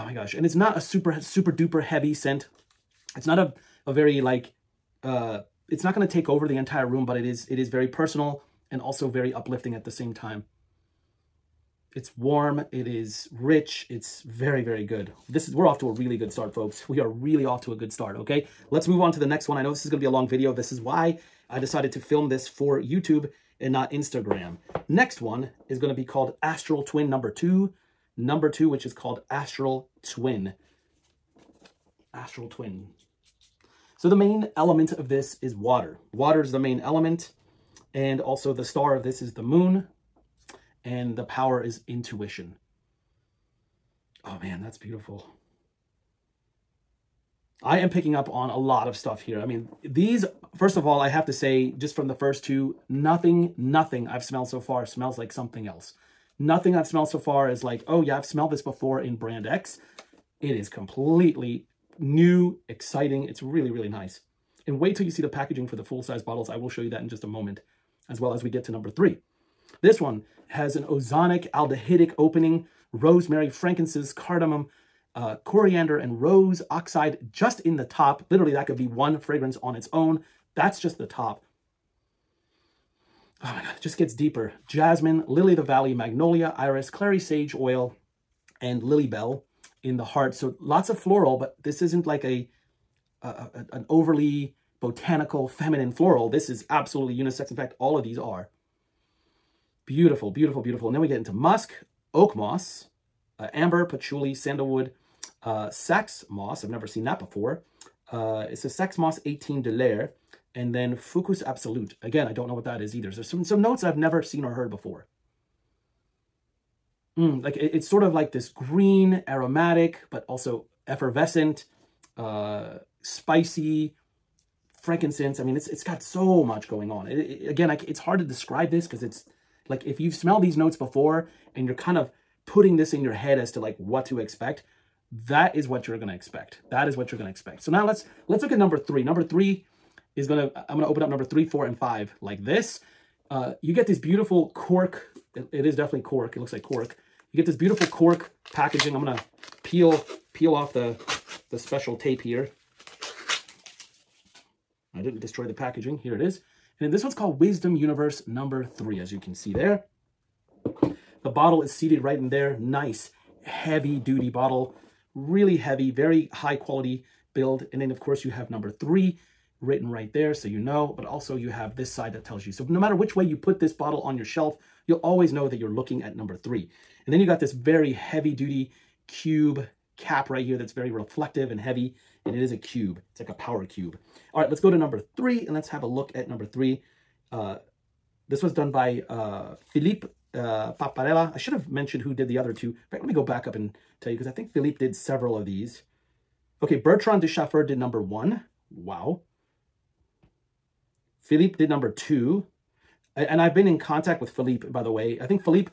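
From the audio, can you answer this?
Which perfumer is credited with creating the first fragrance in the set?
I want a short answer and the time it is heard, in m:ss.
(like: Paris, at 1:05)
Bertrand Duchaufour, at 3:16.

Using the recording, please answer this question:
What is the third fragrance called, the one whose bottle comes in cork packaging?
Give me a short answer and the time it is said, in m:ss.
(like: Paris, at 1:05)
Wisdom Universe, at 2:37.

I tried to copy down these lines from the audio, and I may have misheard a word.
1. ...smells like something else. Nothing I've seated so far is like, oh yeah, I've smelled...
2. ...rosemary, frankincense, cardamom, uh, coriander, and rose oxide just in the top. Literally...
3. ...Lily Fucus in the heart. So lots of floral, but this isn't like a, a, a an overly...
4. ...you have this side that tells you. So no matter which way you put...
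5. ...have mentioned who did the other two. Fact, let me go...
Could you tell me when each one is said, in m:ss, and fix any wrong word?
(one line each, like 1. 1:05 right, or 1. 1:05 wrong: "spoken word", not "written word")
1. 0:54 wrong: "smelled", not "seated"
2. 1:12 right
3. 1:28 wrong: "Bell", not "Fucus"
4. 2:51 right
5. 3:11 right.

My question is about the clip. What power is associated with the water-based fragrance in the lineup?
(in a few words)
Intuition.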